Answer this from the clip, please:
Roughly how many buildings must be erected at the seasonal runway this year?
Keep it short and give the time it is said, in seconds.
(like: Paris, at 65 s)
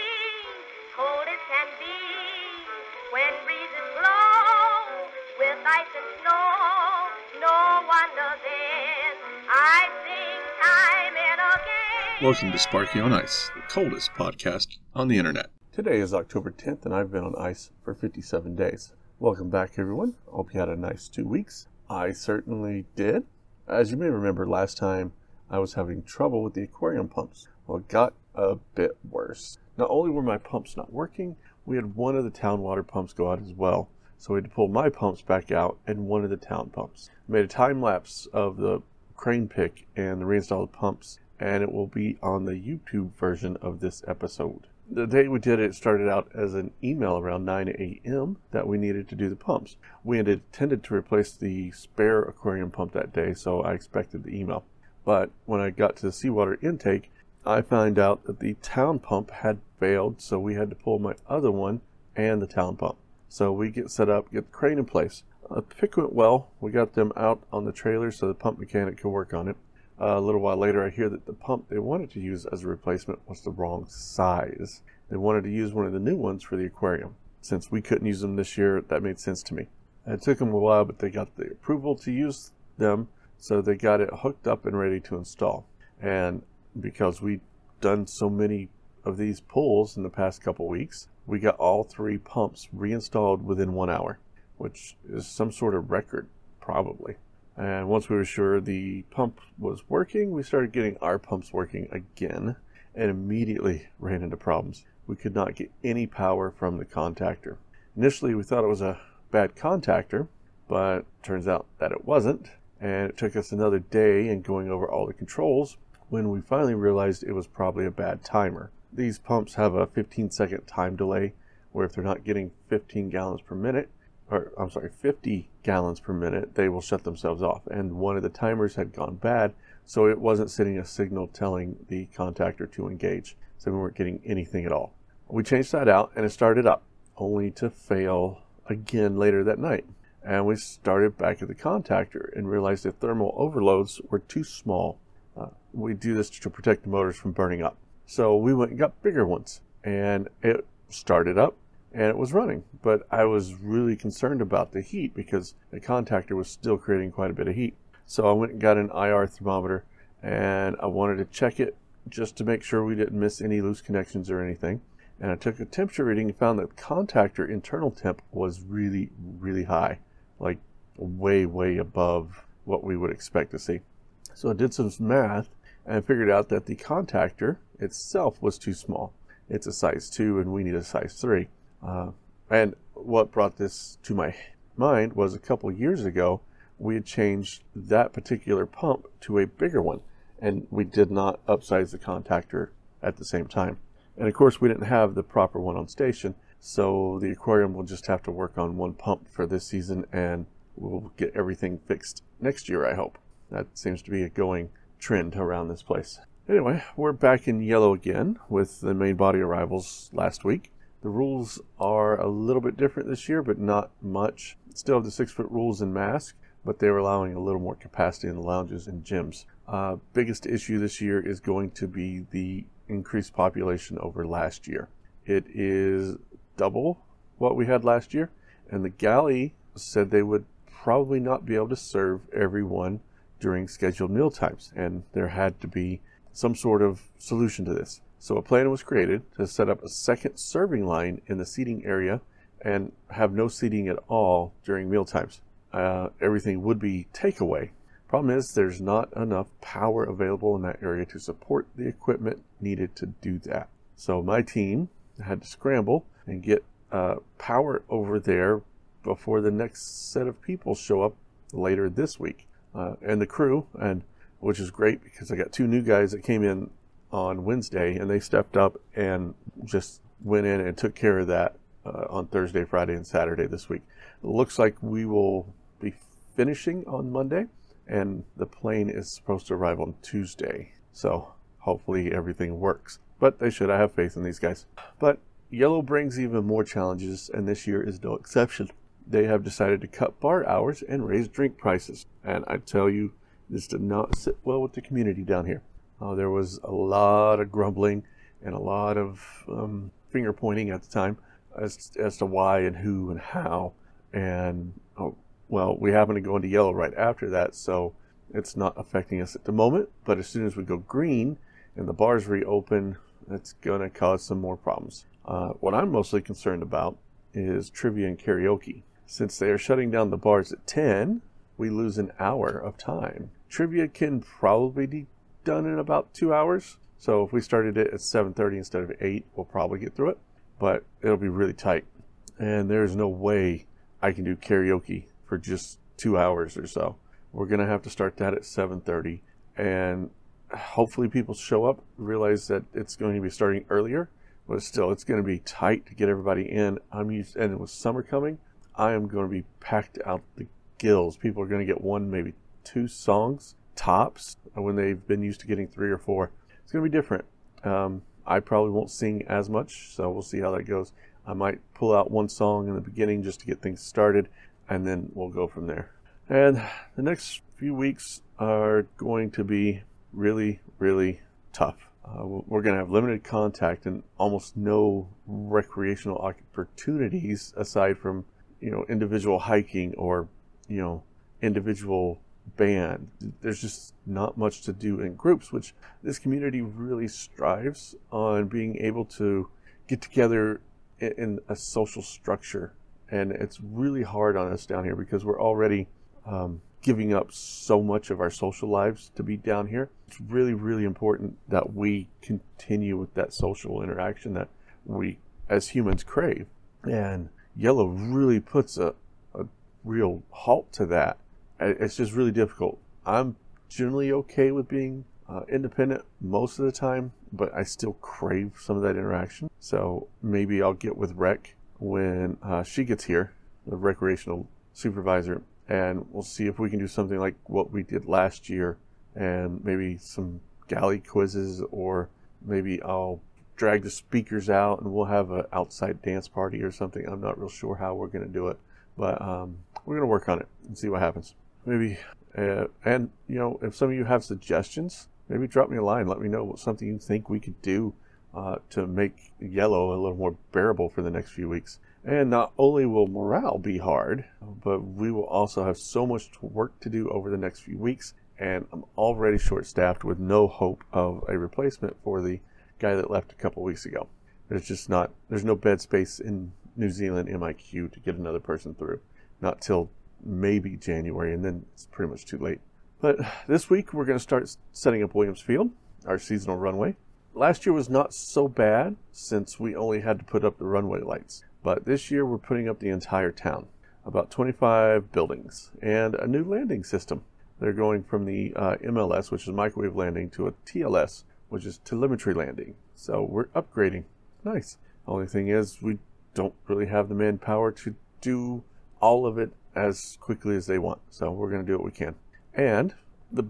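25, at 484 s.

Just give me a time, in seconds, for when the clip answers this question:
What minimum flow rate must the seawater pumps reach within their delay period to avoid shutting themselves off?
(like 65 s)
124 s.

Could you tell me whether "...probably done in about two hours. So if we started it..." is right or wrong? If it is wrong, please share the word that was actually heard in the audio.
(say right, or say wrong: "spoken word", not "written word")
right.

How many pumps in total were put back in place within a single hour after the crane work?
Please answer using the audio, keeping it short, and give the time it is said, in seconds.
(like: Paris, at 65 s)
3, at 91 s.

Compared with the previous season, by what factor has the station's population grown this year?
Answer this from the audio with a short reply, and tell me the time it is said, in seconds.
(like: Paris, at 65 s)
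Double, at 226 s.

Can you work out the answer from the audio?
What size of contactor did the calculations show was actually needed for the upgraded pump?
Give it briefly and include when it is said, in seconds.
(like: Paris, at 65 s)
Size 3, at 180 s.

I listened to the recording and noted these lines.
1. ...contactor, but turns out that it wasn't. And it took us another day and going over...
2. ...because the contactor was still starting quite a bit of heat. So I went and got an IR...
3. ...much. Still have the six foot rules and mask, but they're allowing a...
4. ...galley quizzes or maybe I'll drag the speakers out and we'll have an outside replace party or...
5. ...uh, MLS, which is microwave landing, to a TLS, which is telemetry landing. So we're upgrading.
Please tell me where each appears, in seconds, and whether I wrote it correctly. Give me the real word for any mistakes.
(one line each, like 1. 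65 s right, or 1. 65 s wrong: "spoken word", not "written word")
1. 109 s right
2. 155 s wrong: "creating", not "starting"
3. 214 s right
4. 430 s wrong: "dance", not "replace"
5. 488 s right.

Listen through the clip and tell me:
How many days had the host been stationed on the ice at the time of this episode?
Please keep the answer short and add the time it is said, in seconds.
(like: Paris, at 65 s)
57, at 17 s.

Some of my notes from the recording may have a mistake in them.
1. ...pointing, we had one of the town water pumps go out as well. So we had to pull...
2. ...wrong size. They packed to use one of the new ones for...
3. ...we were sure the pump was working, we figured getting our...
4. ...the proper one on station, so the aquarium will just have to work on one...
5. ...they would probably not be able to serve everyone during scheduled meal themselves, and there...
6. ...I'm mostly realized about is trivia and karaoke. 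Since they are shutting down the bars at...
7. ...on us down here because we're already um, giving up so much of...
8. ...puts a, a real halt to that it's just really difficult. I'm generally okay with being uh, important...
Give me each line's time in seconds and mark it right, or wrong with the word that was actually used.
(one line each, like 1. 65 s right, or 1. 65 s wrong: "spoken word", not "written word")
1. 30 s wrong: "working", not "pointing"
2. 73 s wrong: "wanted", not "packed"
3. 98 s wrong: "started", not "figured"
4. 195 s right
5. 230 s wrong: "times", not "themselves"
6. 315 s wrong: "concerned", not "realized"
7. 394 s right
8. 408 s wrong: "independent", not "important".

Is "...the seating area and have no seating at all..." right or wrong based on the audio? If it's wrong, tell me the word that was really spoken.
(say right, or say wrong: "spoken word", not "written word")
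right.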